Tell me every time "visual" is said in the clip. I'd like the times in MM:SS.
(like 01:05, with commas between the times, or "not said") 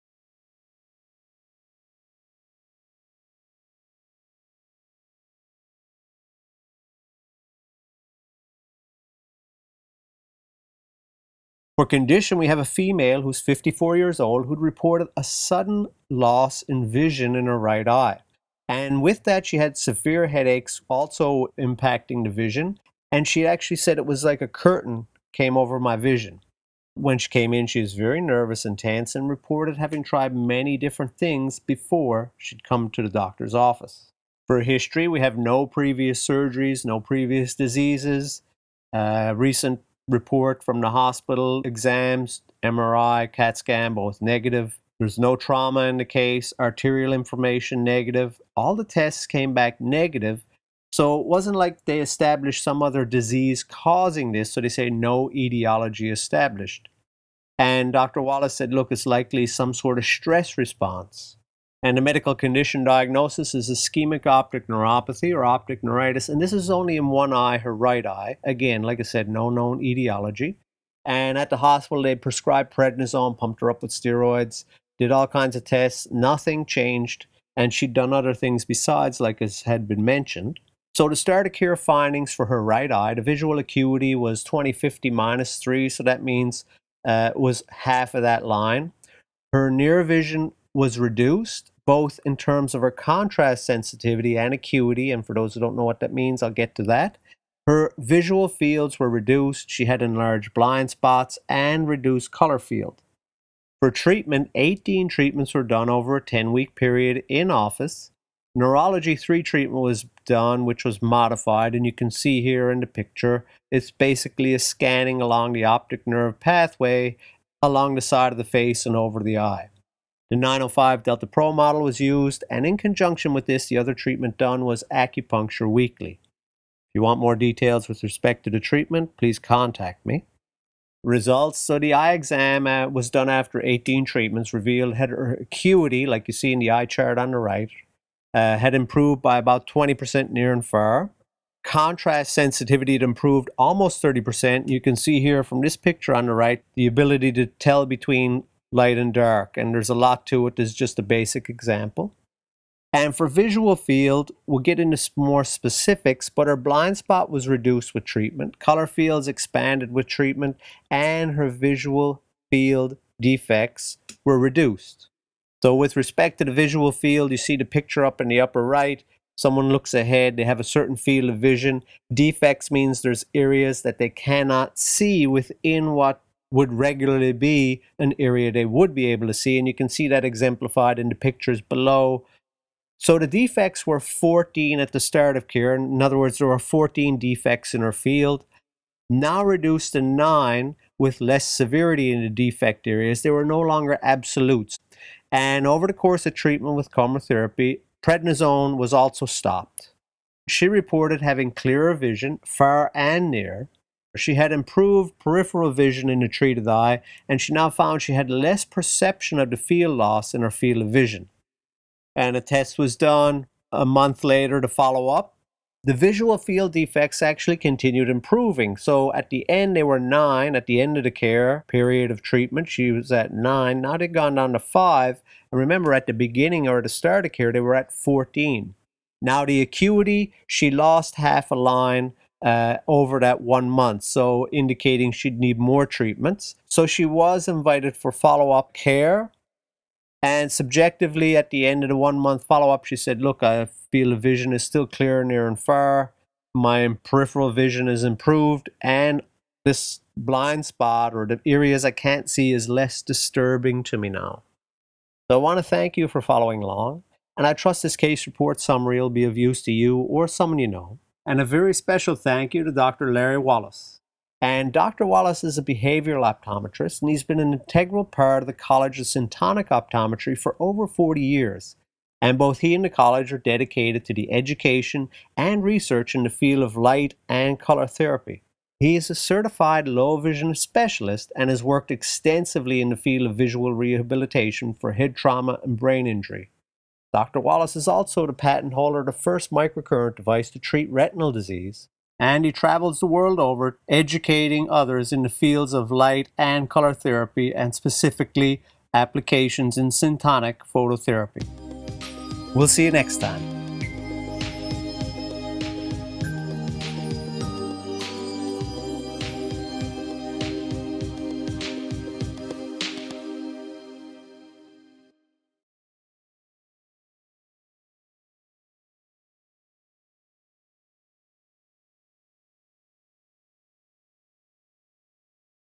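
01:23, 01:37, 02:33, 02:41, 02:46, 03:35, 04:43.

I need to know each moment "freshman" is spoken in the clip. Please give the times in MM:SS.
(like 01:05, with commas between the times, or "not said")
not said.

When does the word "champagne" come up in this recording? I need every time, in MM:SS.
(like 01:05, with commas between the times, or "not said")
not said.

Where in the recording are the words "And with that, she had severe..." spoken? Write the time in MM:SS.
00:18.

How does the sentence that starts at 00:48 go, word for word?
All the tests came back negative.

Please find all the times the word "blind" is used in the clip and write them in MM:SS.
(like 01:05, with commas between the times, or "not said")
01:40, 02:36, 04:10.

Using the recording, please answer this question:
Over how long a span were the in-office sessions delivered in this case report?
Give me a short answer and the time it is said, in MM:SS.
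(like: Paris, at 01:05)
10 weeks, at 01:46.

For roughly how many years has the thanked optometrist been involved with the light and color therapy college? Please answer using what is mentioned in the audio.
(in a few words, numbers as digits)
Over 40 years.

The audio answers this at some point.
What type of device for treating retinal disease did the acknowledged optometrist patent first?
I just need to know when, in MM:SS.
04:49.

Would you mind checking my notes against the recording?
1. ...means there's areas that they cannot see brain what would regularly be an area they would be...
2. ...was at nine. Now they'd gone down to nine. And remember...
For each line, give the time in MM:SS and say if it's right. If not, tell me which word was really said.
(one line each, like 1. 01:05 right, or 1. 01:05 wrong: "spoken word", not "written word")
1. 02:52 wrong: "within", not "brain"
2. 03:42 wrong: "five", not "nine".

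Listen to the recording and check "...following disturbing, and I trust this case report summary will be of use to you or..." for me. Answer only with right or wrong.
wrong.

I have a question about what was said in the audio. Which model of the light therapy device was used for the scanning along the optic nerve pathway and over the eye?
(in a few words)
905 Delta Pro.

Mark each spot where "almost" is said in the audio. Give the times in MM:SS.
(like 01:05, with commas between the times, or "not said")
02:23.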